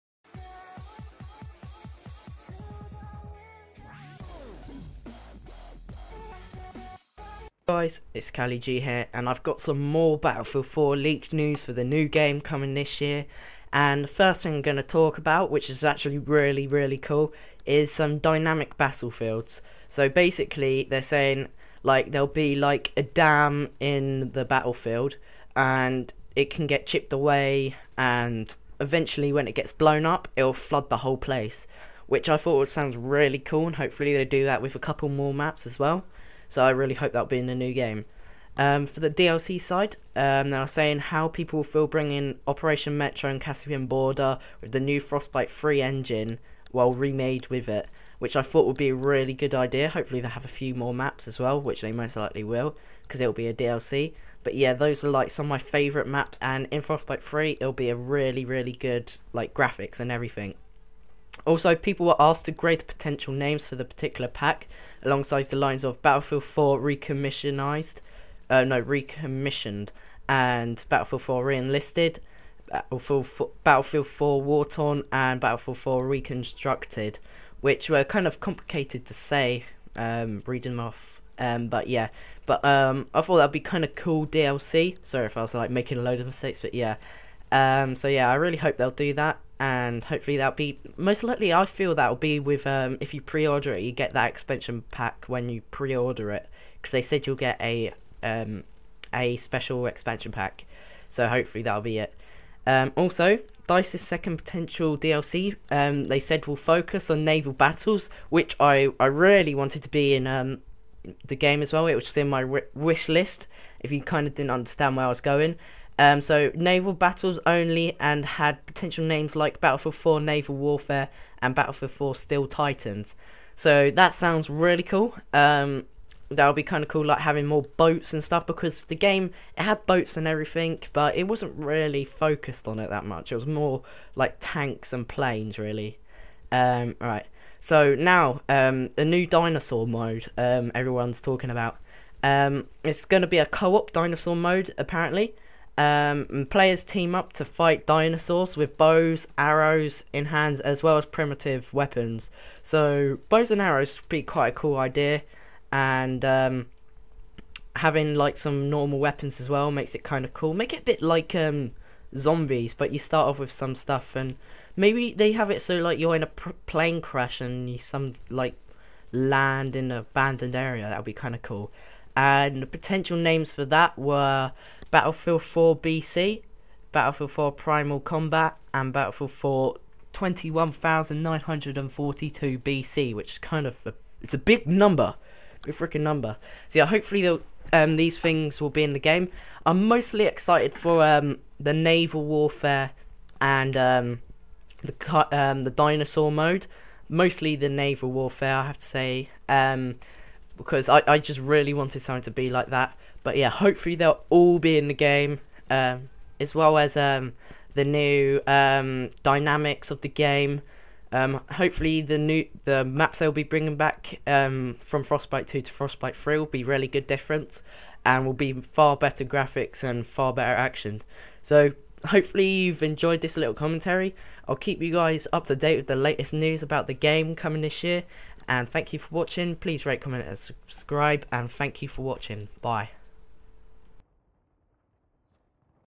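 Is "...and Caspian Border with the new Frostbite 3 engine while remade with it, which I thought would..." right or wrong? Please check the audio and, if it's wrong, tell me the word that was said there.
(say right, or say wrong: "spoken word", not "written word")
right.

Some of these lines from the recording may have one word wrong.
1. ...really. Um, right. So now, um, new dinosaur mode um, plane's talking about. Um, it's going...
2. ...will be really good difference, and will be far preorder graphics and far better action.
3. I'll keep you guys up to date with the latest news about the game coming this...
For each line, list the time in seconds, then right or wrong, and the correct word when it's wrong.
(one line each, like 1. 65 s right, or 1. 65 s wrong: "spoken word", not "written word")
1. 135 s wrong: "everyone", not "plane"
2. 216 s wrong: "better", not "preorder"
3. 224 s right.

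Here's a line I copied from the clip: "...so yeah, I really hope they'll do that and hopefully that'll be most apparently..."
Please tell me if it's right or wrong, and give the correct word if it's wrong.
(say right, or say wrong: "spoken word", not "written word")
wrong: "likely", not "apparently".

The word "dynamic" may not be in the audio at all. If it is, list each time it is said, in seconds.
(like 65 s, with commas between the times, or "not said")
18 s, 209 s.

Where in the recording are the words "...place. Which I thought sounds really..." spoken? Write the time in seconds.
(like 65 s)
31 s.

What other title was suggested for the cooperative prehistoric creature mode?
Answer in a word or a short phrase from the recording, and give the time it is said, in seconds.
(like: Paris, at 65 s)
Battlefield 4 Primal Combat, at 176 s.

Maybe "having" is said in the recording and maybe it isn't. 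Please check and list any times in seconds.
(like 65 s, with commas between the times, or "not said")
127 s, 157 s.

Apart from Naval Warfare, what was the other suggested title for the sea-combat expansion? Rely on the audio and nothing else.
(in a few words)
Battlefield 4 Steel Titans.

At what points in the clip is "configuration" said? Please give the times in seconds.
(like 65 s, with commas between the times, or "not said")
not said.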